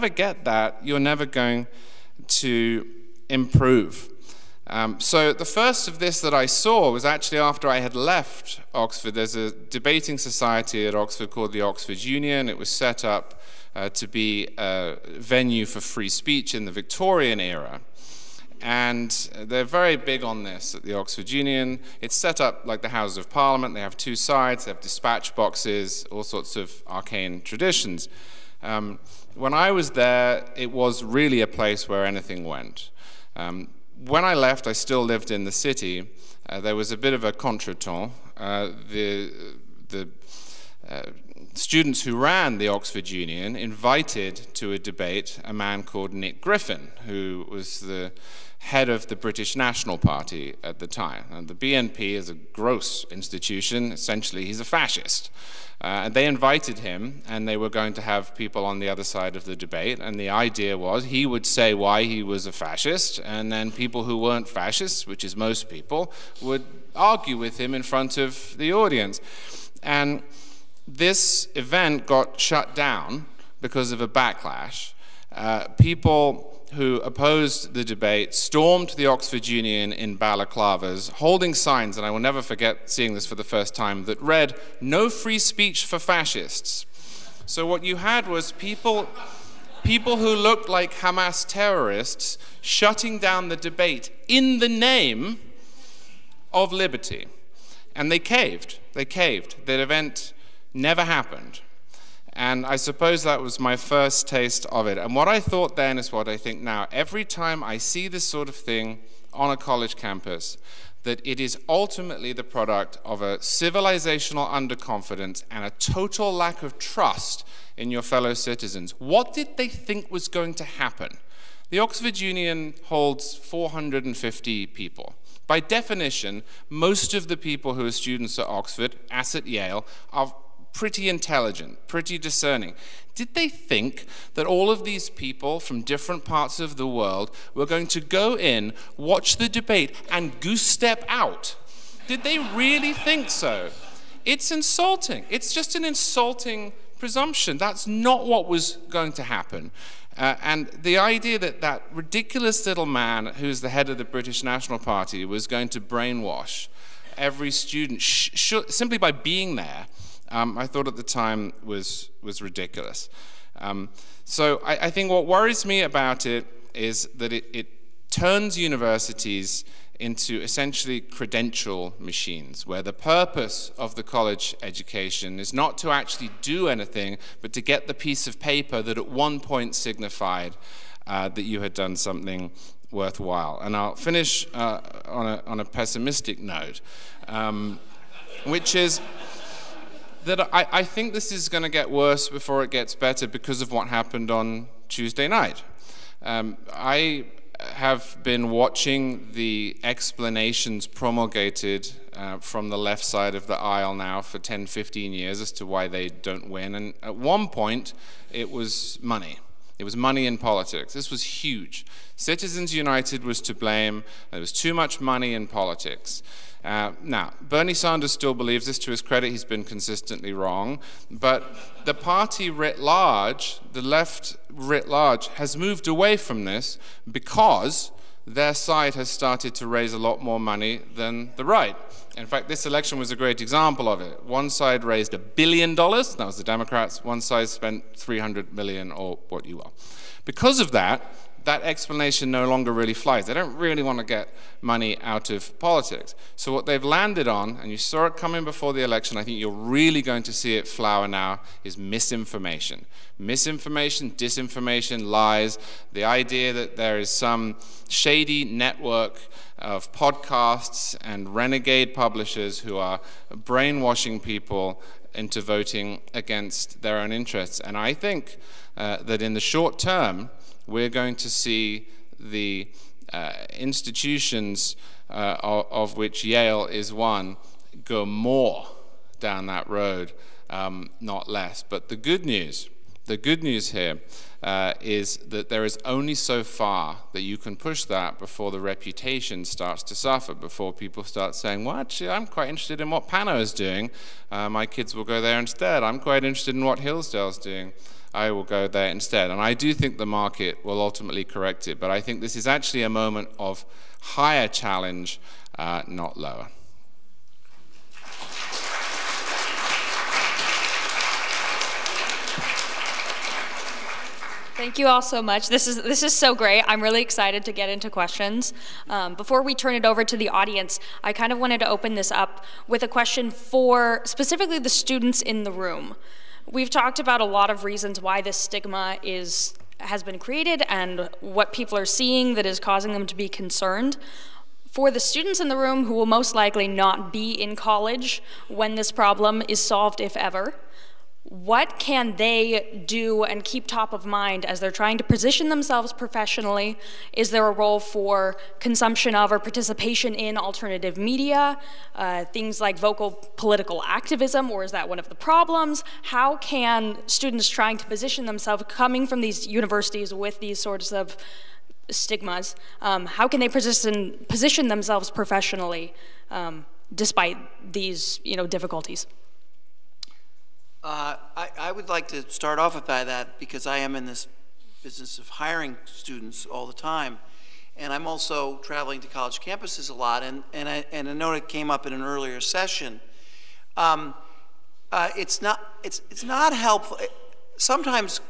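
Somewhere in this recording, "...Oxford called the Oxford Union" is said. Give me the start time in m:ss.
0:10.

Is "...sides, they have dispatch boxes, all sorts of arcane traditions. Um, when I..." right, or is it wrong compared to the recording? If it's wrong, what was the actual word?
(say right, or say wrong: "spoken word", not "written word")
right.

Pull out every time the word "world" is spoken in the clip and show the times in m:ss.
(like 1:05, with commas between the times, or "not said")
2:16.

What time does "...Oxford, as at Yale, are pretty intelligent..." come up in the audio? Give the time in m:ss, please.
2:08.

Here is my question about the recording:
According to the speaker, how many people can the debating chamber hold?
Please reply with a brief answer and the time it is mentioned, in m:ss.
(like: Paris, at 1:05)
450, at 2:03.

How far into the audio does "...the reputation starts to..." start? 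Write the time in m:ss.
4:48.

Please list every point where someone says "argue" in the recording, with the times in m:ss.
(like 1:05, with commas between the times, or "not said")
1:06.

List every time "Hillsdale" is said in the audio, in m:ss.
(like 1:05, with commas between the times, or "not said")
4:56.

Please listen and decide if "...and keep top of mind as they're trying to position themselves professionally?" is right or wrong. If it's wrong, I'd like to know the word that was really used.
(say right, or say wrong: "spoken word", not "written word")
right.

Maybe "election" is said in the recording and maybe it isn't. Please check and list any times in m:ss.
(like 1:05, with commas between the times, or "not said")
3:52, 4:08.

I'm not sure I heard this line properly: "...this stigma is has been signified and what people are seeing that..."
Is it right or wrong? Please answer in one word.
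wrong.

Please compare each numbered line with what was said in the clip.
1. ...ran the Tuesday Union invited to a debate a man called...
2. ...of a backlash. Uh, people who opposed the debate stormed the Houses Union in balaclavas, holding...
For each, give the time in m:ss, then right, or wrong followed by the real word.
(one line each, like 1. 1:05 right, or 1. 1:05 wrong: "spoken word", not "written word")
1. 0:42 wrong: "Oxford", not "Tuesday"
2. 1:13 wrong: "Oxford", not "Houses".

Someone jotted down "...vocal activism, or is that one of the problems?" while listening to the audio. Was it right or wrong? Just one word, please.
wrong.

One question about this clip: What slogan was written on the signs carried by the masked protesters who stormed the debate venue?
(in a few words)
No free speech for fascists.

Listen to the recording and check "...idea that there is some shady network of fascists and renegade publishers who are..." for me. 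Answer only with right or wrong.
wrong.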